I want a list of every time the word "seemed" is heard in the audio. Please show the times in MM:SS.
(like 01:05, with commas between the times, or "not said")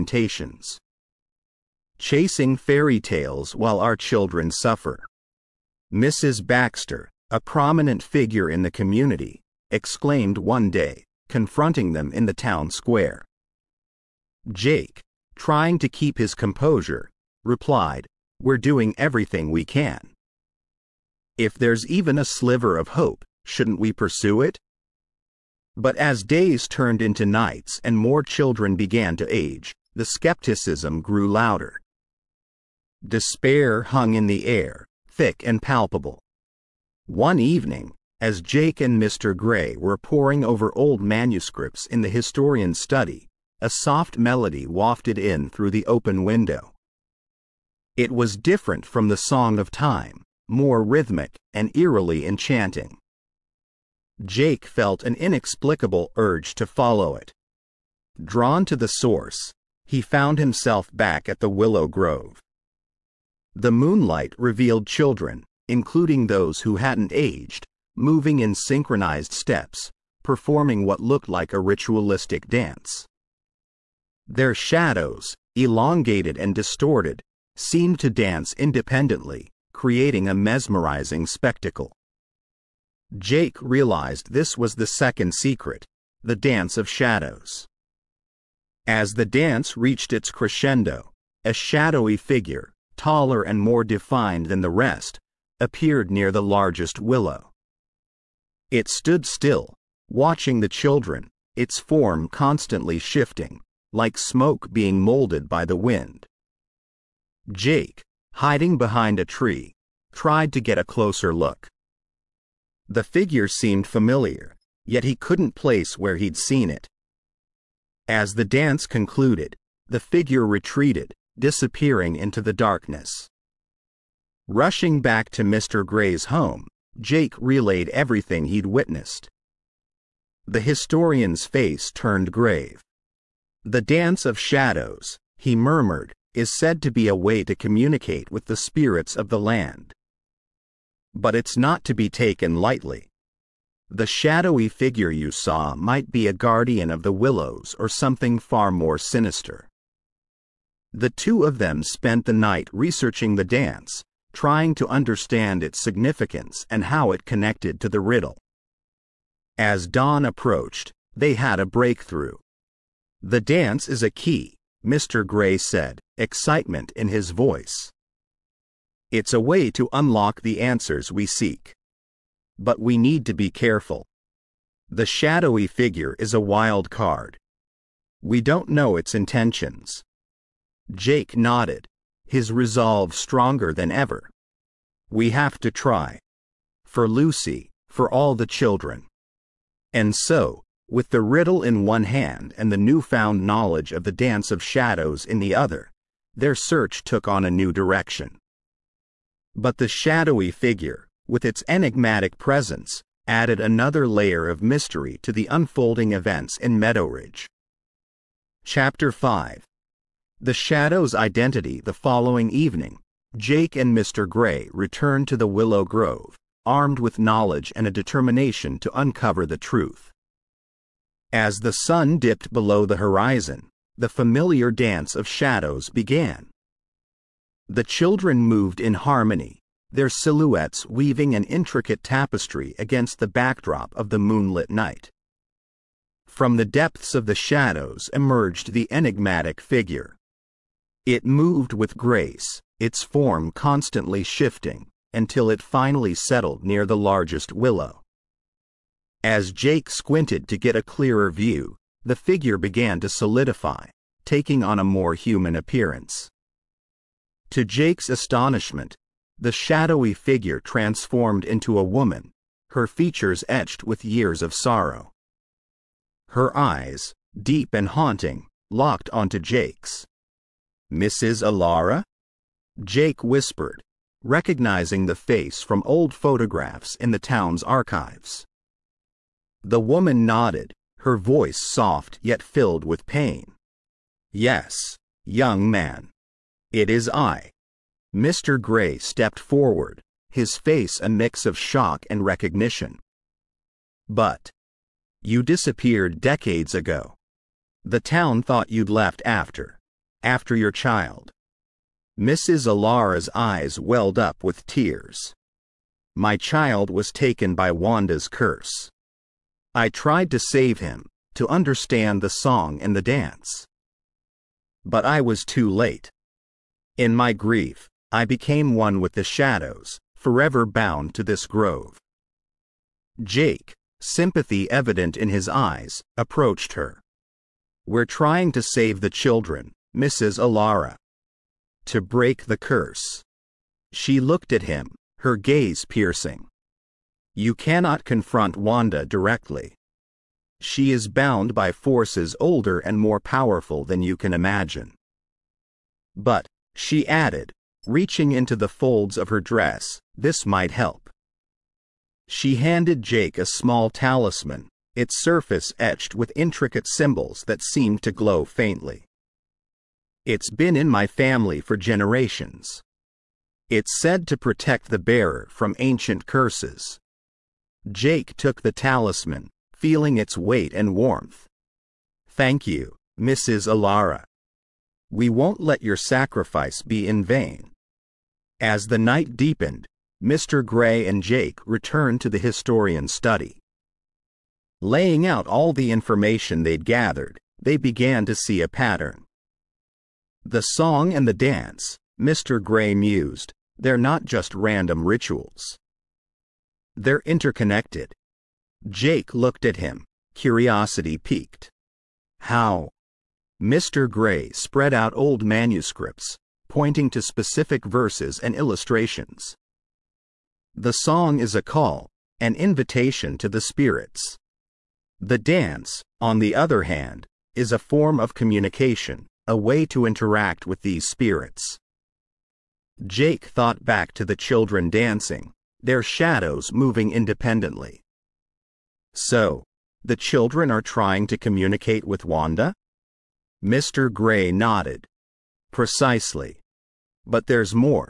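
01:17, 01:53, 05:57.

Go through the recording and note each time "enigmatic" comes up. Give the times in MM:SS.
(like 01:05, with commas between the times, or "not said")
03:21, 03:58.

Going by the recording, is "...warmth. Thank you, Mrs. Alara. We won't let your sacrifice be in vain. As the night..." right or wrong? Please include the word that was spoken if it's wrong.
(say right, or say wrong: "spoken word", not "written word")
right.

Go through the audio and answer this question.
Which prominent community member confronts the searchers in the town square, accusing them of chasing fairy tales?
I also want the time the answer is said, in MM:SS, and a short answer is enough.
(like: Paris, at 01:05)
Mrs. Baxter, at 00:05.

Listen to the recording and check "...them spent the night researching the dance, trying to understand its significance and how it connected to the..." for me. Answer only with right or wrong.
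right.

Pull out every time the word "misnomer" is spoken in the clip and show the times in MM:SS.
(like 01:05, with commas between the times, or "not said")
not said.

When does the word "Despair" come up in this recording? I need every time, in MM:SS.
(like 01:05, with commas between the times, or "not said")
00:33.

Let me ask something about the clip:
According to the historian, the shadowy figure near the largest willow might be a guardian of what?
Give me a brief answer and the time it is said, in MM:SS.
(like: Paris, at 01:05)
the willows, at 02:26.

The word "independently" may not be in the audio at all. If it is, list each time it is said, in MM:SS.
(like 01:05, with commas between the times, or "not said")
01:18, 07:07.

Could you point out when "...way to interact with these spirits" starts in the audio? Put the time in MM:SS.
06:59.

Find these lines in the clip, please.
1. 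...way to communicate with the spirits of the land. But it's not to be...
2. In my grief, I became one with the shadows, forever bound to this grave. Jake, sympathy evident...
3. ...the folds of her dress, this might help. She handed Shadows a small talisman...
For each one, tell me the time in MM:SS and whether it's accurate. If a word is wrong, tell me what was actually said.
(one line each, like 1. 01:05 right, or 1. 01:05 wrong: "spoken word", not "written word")
1. 02:17 right
2. 05:16 wrong: "grove", not "grave"
3. 05:48 wrong: "Jake", not "Shadows".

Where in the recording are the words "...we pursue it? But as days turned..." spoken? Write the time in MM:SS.
00:23.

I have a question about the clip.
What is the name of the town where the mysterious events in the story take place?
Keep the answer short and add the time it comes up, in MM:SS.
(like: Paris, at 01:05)
Meadowridge, at 03:26.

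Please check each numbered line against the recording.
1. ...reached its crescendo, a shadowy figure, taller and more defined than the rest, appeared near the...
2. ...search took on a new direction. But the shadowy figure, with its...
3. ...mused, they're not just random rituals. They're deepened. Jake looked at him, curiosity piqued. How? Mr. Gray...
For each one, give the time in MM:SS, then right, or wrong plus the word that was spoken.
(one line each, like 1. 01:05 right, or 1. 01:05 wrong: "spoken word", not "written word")
1. 01:29 right
2. 03:16 right
3. 06:32 wrong: "interconnected", not "deepened".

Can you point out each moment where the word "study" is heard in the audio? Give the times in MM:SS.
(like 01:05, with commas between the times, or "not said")
00:42, 06:23.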